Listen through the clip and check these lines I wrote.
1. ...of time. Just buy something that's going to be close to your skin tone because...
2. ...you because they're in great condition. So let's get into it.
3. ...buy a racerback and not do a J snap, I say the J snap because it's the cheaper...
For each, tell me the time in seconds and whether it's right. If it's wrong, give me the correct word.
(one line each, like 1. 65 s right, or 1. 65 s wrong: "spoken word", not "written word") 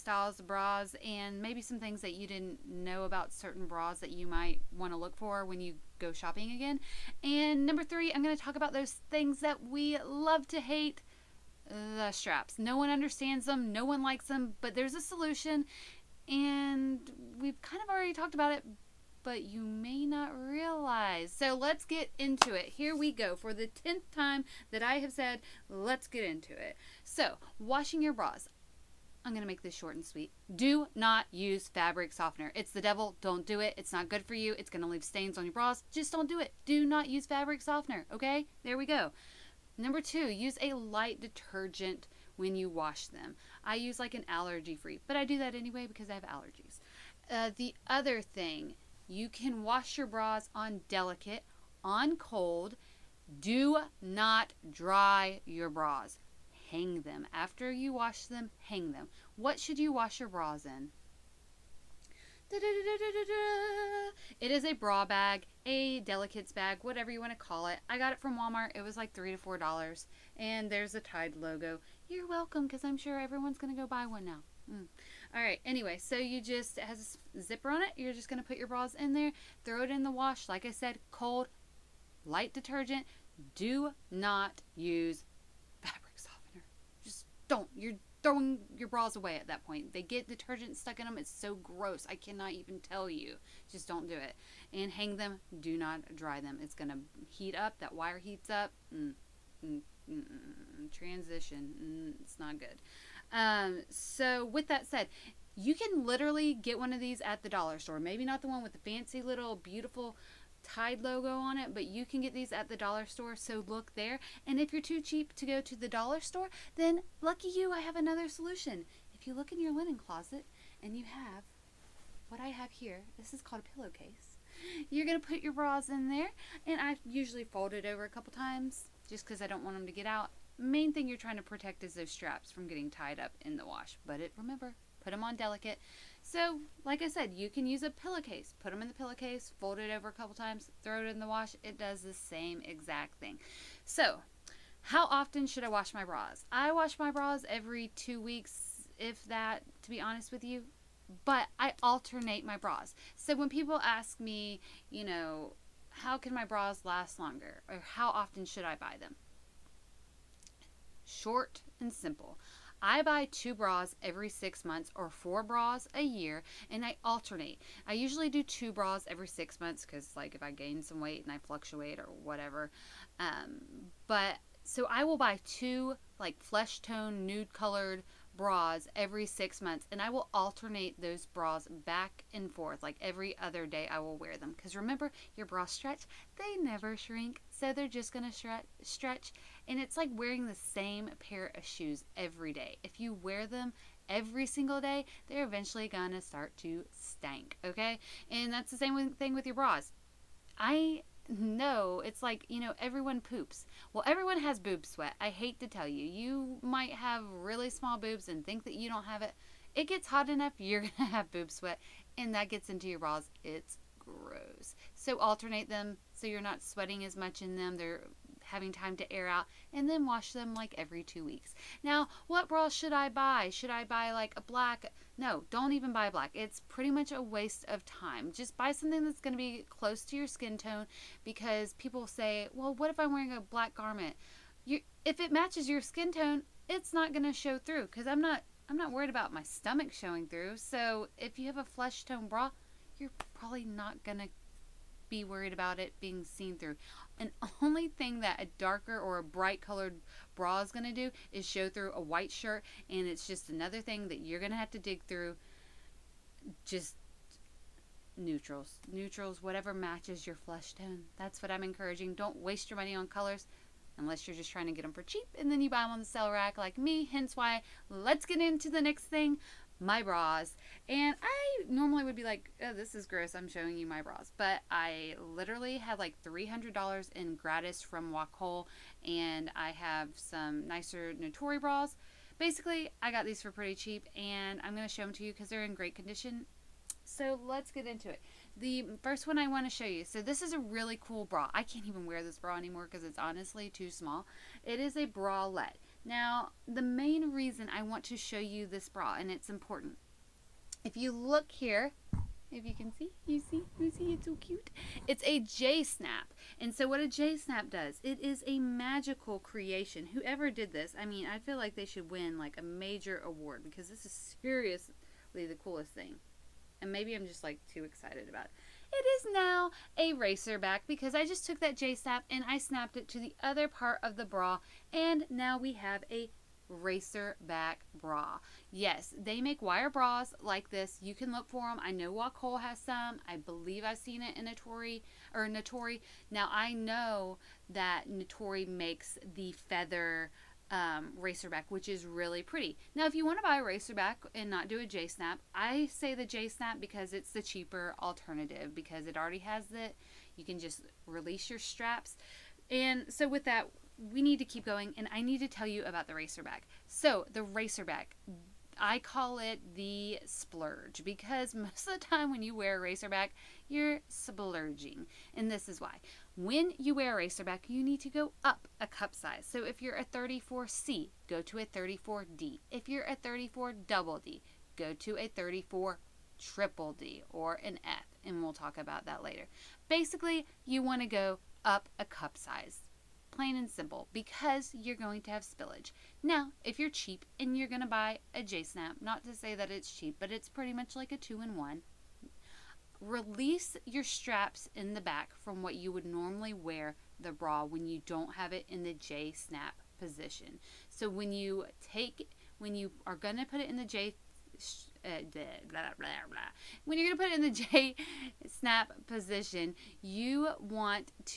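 1. 227 s right
2. 285 s right
3. 343 s right.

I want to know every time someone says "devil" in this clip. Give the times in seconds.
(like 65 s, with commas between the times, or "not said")
32 s.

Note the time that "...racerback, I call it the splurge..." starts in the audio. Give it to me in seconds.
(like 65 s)
357 s.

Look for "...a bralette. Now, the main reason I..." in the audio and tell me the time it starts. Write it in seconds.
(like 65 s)
294 s.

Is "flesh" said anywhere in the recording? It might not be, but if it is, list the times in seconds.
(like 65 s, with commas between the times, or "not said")
176 s, 241 s, 260 s.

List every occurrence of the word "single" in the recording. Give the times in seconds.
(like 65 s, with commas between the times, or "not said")
194 s.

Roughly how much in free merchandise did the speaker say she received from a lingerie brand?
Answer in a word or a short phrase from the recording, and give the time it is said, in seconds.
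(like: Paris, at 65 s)
$300, at 276 s.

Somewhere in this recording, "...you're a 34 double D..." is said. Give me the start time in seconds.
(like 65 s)
372 s.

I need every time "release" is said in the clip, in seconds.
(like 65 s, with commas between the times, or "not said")
351 s, 392 s.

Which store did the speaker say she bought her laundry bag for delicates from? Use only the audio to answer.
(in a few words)
Walmart.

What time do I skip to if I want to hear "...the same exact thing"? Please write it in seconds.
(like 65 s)
142 s.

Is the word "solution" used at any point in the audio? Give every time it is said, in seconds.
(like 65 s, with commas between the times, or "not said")
15 s, 118 s.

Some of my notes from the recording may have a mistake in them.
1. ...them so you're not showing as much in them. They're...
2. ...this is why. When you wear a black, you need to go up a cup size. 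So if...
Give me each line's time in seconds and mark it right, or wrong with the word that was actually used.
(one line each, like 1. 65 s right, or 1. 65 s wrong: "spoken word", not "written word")
1. 215 s wrong: "sweating", not "showing"
2. 365 s wrong: "racerback", not "black".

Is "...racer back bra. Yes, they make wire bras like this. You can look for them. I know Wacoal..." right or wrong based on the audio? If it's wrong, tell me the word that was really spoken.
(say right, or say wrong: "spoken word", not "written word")
right.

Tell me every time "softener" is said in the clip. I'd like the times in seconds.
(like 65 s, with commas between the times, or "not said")
32 s, 37 s, 86 s.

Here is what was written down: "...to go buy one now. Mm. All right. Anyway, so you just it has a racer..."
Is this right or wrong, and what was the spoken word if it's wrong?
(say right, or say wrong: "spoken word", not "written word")
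wrong: "zipper", not "racer".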